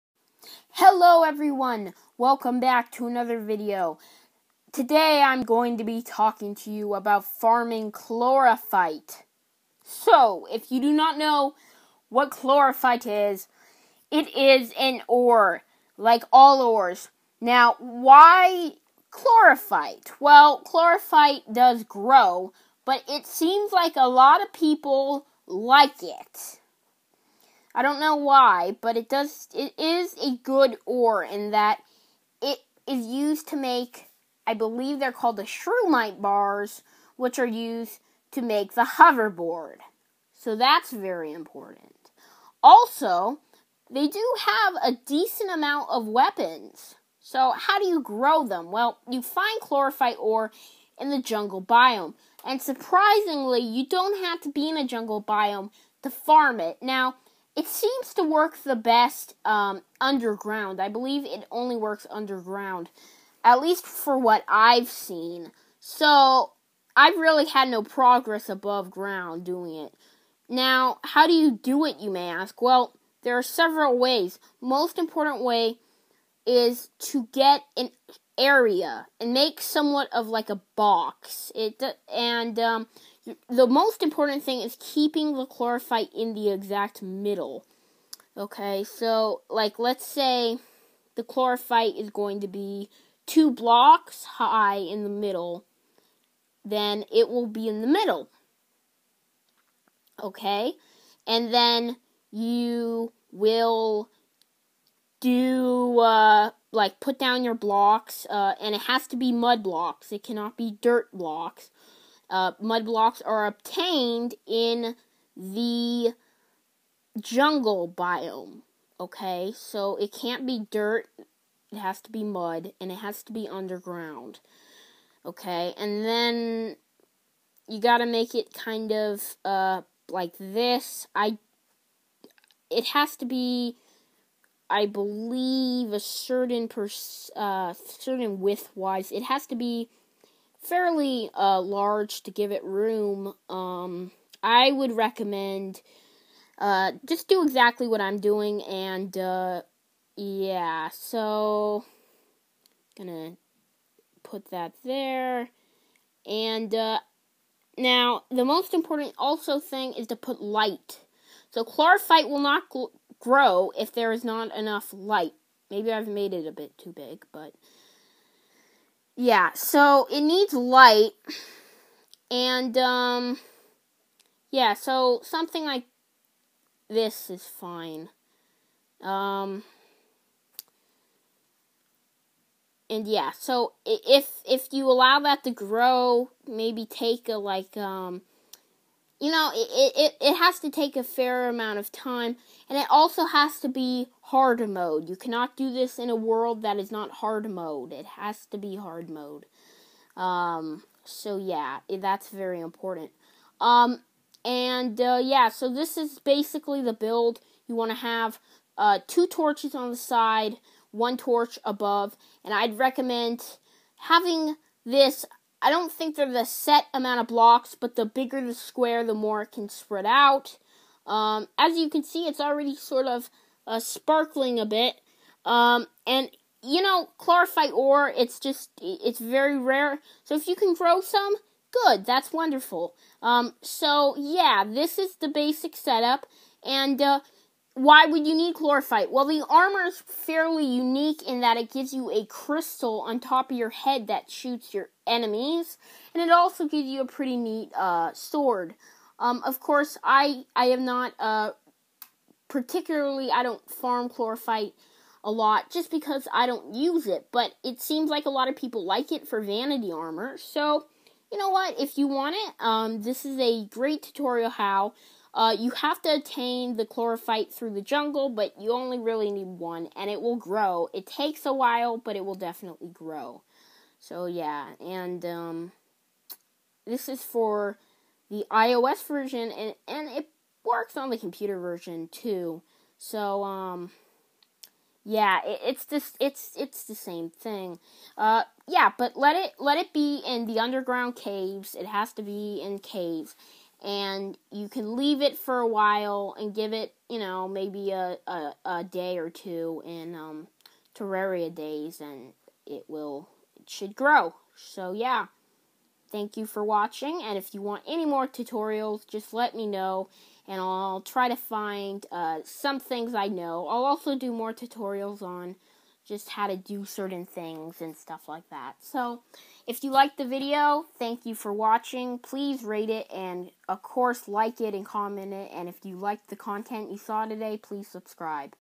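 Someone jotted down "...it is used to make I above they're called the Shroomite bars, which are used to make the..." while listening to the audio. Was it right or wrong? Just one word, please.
wrong.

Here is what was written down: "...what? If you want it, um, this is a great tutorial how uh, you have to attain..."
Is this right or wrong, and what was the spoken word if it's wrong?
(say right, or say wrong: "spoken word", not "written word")
right.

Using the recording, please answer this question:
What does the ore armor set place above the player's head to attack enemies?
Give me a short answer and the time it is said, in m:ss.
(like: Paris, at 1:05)
A crystal, at 4:02.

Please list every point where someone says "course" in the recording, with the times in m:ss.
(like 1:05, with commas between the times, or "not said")
4:09, 5:23.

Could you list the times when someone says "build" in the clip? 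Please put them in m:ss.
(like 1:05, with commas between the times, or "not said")
3:26.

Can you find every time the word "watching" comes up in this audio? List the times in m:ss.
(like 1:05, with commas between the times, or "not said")
5:06, 5:21.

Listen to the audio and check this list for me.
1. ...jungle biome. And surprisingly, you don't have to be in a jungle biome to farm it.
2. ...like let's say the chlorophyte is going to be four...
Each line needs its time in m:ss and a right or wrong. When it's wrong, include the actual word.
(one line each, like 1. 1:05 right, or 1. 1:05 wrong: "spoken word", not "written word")
1. 0:51 right
2. 1:29 wrong: "two", not "four".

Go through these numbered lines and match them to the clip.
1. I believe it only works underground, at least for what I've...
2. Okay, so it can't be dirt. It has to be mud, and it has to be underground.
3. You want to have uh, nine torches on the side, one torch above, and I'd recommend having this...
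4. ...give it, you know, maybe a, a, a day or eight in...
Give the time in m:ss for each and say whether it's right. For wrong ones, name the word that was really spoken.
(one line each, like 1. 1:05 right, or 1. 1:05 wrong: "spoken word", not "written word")
1. 1:00 right
2. 1:58 right
3. 3:27 wrong: "two", not "nine"
4. 4:56 wrong: "two", not "eight".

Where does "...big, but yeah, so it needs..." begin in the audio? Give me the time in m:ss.
2:46.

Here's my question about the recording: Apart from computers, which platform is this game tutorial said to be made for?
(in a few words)
iOS.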